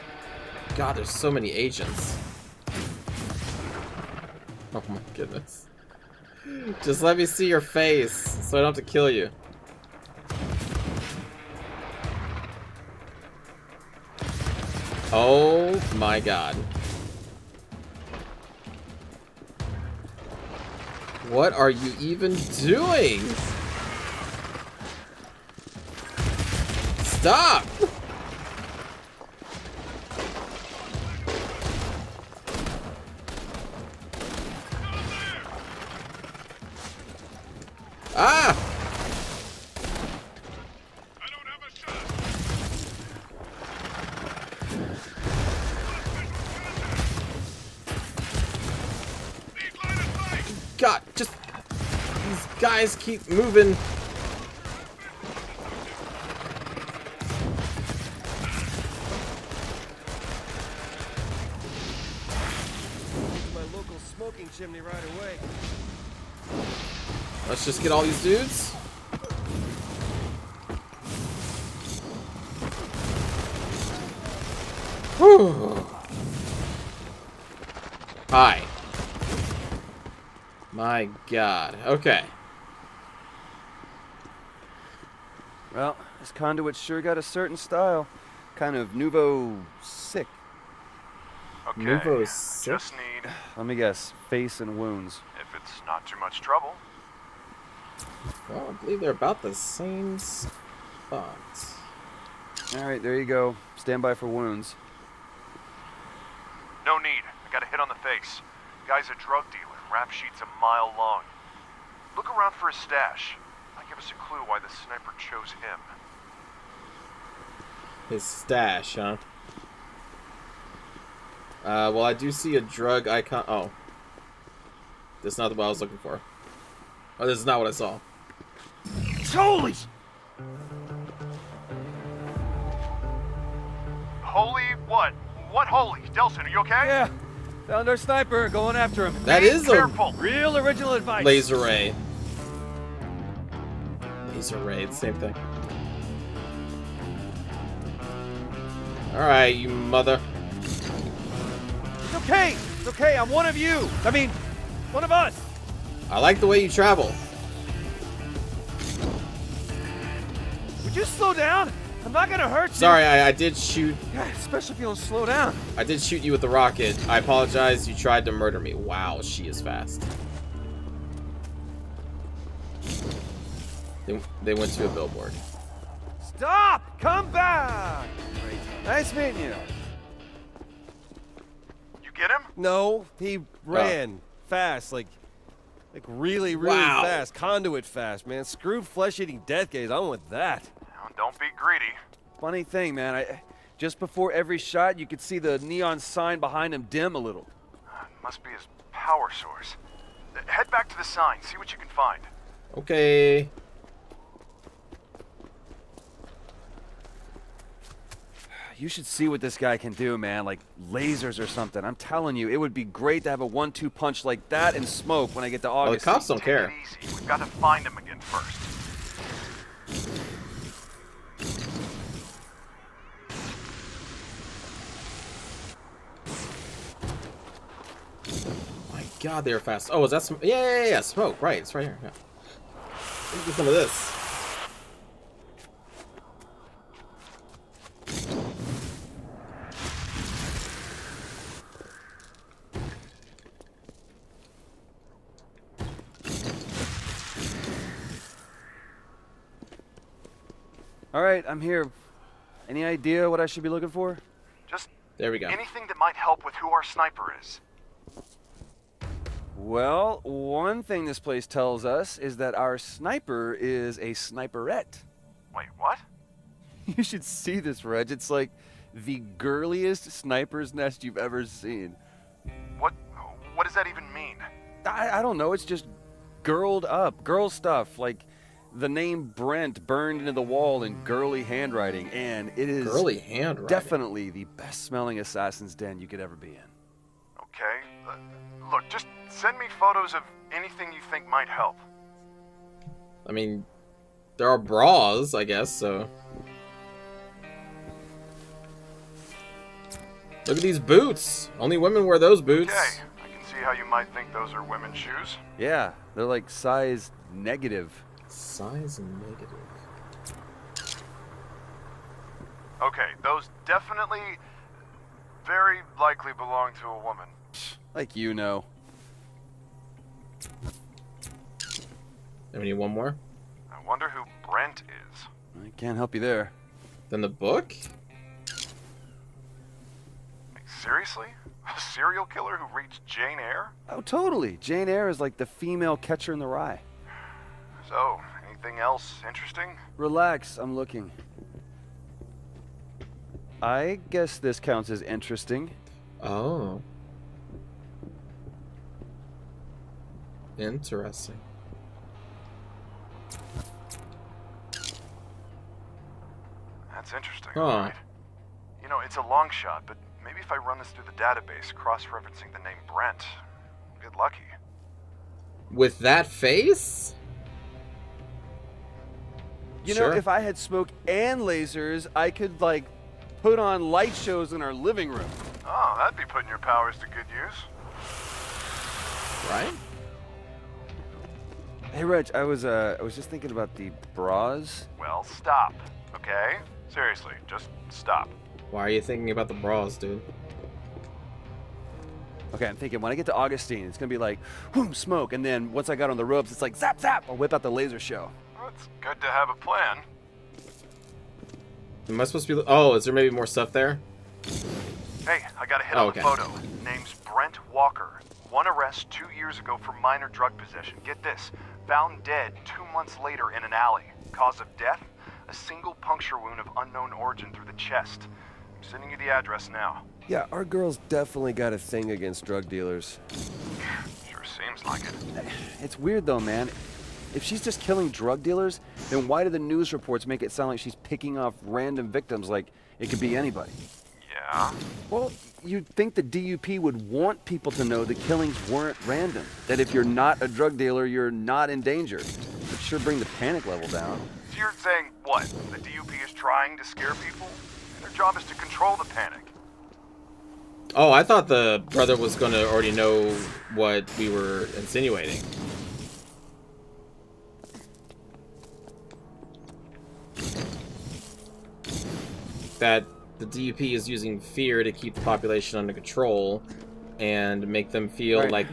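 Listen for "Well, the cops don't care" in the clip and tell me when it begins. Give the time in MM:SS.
03:36.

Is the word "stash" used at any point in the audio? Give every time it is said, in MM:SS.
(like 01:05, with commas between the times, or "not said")
01:52, 01:58.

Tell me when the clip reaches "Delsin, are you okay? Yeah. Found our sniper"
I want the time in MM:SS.
02:16.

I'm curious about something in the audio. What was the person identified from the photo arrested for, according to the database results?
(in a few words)
minor drug possession.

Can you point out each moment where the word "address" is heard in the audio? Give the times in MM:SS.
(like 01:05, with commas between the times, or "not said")
06:59.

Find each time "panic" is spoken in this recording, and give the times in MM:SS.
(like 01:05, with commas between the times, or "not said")
07:23, 07:29.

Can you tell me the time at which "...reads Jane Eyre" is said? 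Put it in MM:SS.
05:32.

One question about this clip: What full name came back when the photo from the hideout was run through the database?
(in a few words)
Brent Walker.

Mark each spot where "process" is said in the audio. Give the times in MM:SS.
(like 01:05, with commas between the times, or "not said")
not said.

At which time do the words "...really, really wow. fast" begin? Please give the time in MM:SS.
03:06.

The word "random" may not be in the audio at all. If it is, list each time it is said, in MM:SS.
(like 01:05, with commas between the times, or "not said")
07:11, 07:19.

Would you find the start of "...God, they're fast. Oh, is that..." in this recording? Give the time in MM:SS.
03:49.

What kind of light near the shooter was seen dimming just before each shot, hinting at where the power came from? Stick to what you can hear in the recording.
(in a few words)
neon sign.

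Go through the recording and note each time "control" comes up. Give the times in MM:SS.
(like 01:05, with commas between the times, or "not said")
07:28, 07:45.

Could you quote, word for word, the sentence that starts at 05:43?
I guess this counts as interesting.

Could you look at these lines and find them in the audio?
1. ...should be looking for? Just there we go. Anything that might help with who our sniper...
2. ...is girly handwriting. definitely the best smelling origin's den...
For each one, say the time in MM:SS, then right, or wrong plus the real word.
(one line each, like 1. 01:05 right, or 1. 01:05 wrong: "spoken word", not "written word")
1. 04:13 right
2. 04:42 wrong: "assassin", not "origin".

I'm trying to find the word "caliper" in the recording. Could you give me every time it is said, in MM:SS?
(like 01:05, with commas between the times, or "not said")
not said.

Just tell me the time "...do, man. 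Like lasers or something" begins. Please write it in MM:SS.
03:29.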